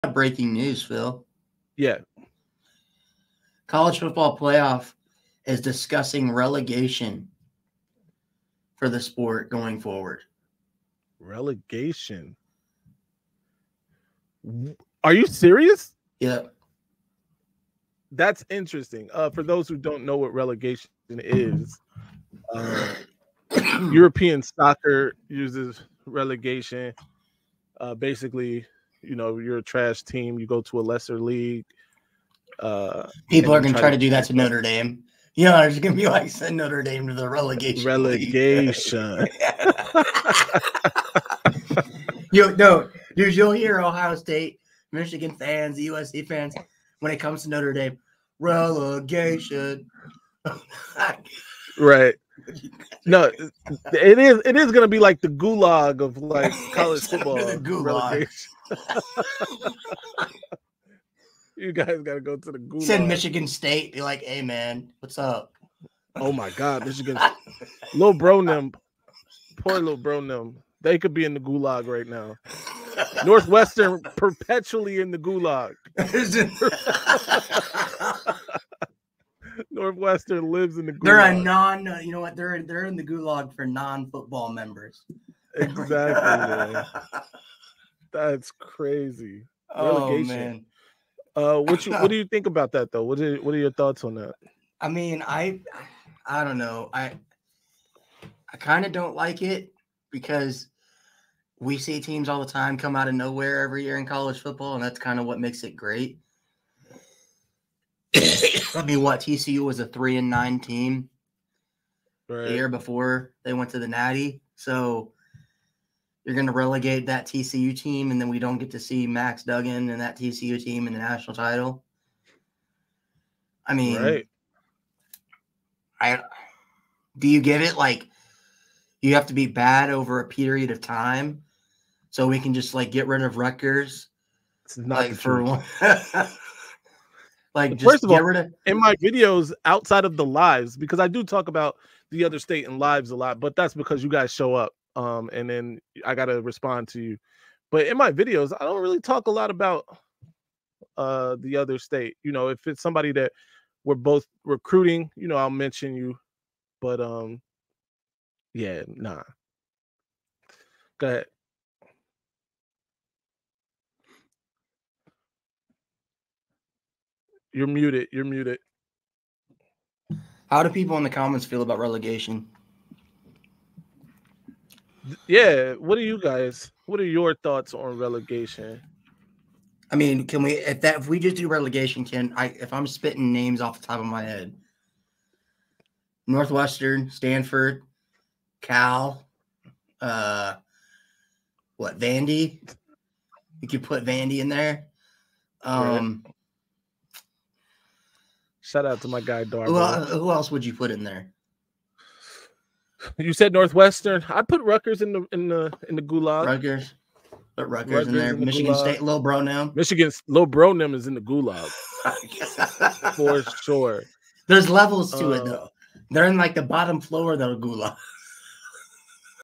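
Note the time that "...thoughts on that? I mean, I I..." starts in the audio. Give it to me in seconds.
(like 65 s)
93 s.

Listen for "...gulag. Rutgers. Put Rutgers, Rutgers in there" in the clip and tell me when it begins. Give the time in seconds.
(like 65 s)
206 s.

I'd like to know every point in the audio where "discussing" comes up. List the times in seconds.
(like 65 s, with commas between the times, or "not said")
5 s.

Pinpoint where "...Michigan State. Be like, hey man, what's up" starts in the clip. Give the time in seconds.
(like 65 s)
63 s.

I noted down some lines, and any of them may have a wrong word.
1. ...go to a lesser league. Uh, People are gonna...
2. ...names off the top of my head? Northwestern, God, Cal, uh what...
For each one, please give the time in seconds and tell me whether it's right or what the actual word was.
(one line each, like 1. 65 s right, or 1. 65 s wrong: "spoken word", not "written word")
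1. 30 s right
2. 183 s wrong: "Stanford", not "God".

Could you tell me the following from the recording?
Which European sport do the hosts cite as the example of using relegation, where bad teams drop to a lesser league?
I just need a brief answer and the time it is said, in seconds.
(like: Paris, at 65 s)
European soccer, at 23 s.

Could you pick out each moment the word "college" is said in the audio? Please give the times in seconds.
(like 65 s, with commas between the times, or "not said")
3 s, 56 s, 104 s.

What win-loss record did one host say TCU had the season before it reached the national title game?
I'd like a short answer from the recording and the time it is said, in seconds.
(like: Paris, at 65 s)
3 and 9, at 109 s.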